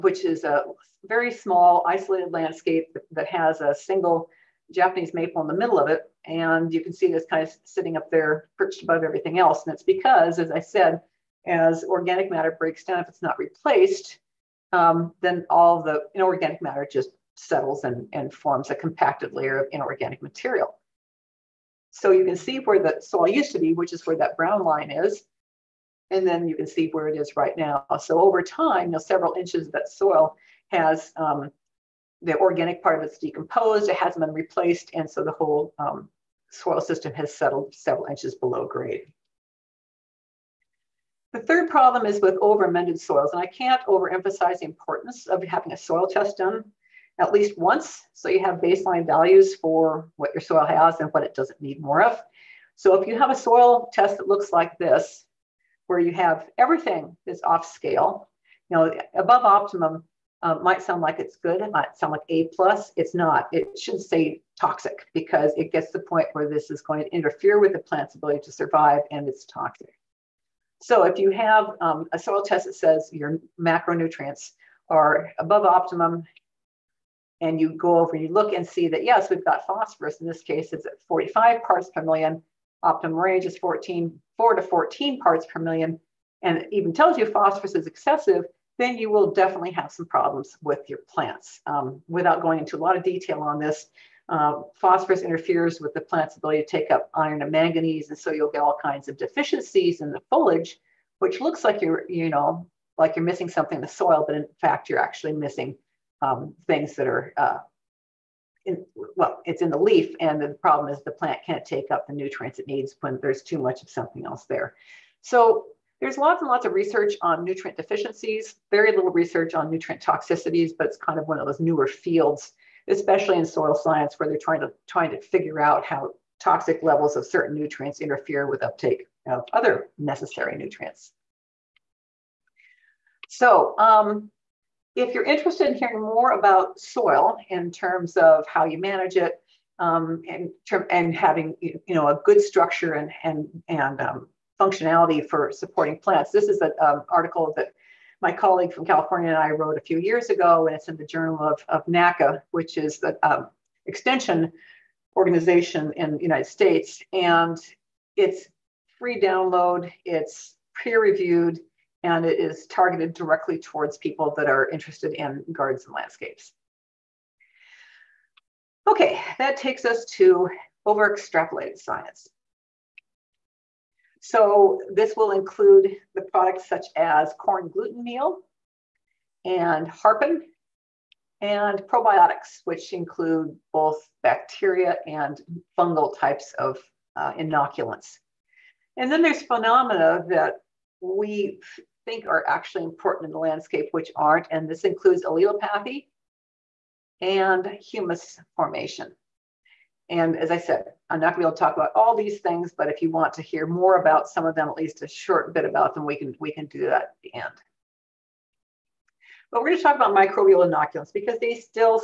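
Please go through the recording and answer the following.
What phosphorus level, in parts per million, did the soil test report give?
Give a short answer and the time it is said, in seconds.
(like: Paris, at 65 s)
45, at 81 s.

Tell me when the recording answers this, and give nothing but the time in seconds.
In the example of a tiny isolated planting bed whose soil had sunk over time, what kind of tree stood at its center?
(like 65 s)
4 s.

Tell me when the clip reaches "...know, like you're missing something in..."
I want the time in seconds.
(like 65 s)
102 s.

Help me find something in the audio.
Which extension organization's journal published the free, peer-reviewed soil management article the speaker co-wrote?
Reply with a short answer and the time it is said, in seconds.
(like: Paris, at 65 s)
NACAA, at 151 s.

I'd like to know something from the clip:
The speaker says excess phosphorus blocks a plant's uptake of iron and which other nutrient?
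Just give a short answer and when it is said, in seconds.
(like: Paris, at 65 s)
manganese, at 97 s.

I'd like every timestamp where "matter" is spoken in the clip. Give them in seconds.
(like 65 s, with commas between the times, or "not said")
12 s, 16 s.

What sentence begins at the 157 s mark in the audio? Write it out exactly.
And it's free download, it's peer reviewed, and it is targeted directly towards people that are interested in gardens and landscapes.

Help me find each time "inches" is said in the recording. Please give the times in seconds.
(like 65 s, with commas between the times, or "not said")
29 s, 38 s.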